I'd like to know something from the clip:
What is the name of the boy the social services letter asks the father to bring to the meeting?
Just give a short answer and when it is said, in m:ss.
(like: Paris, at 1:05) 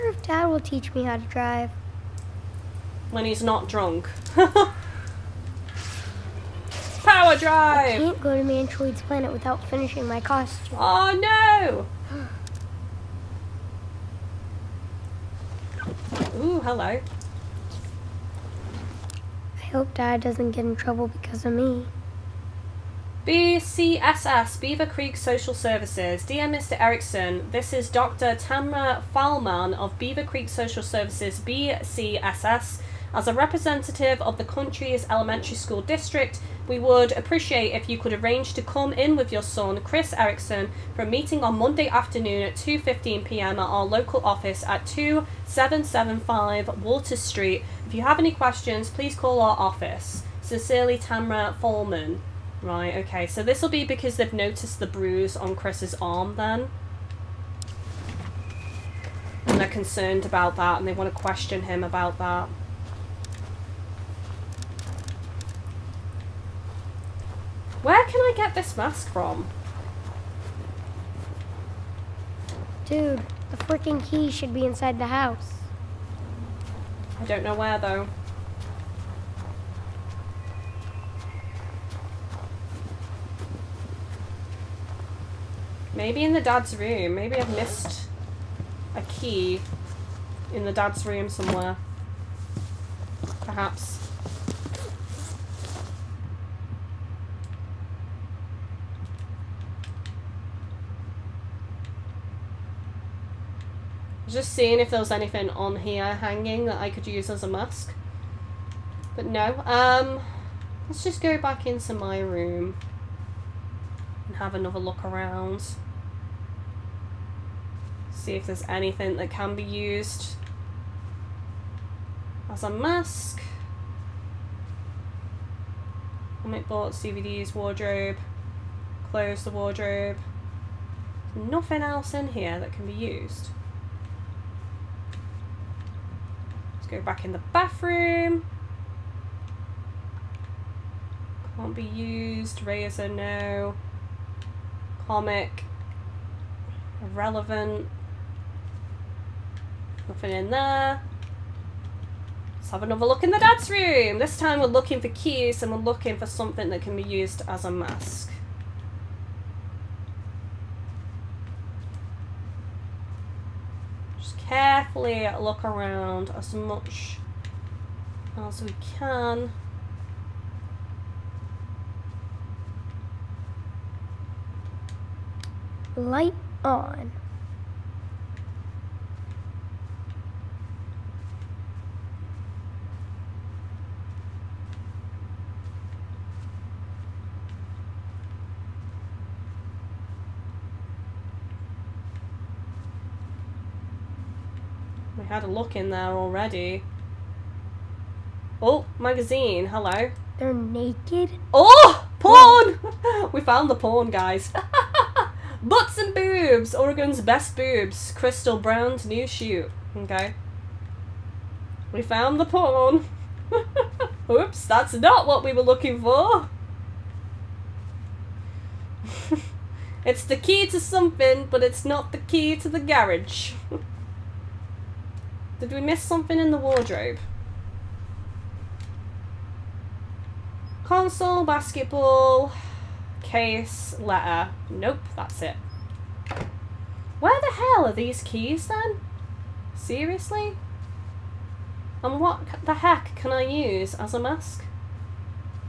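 Chris Eriksen, at 0:39.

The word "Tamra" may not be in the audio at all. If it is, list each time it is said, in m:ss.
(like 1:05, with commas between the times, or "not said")
0:28, 0:50.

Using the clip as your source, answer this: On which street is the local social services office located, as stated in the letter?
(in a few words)
Walter Street.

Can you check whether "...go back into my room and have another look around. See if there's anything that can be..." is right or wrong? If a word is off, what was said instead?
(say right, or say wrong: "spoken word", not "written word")
right.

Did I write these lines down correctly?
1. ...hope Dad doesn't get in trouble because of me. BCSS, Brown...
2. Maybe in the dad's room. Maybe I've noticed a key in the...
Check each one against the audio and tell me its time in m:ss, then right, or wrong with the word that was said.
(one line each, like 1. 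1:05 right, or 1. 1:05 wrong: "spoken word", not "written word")
1. 0:19 wrong: "Beaver", not "Brown"
2. 1:25 wrong: "missed", not "noticed".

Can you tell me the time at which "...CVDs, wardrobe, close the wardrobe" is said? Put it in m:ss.
2:06.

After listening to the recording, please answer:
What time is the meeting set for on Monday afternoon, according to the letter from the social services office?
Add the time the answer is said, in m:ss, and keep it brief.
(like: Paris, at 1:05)
2:15 p.m., at 0:42.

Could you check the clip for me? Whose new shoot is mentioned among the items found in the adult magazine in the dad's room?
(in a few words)
Crystal Brown.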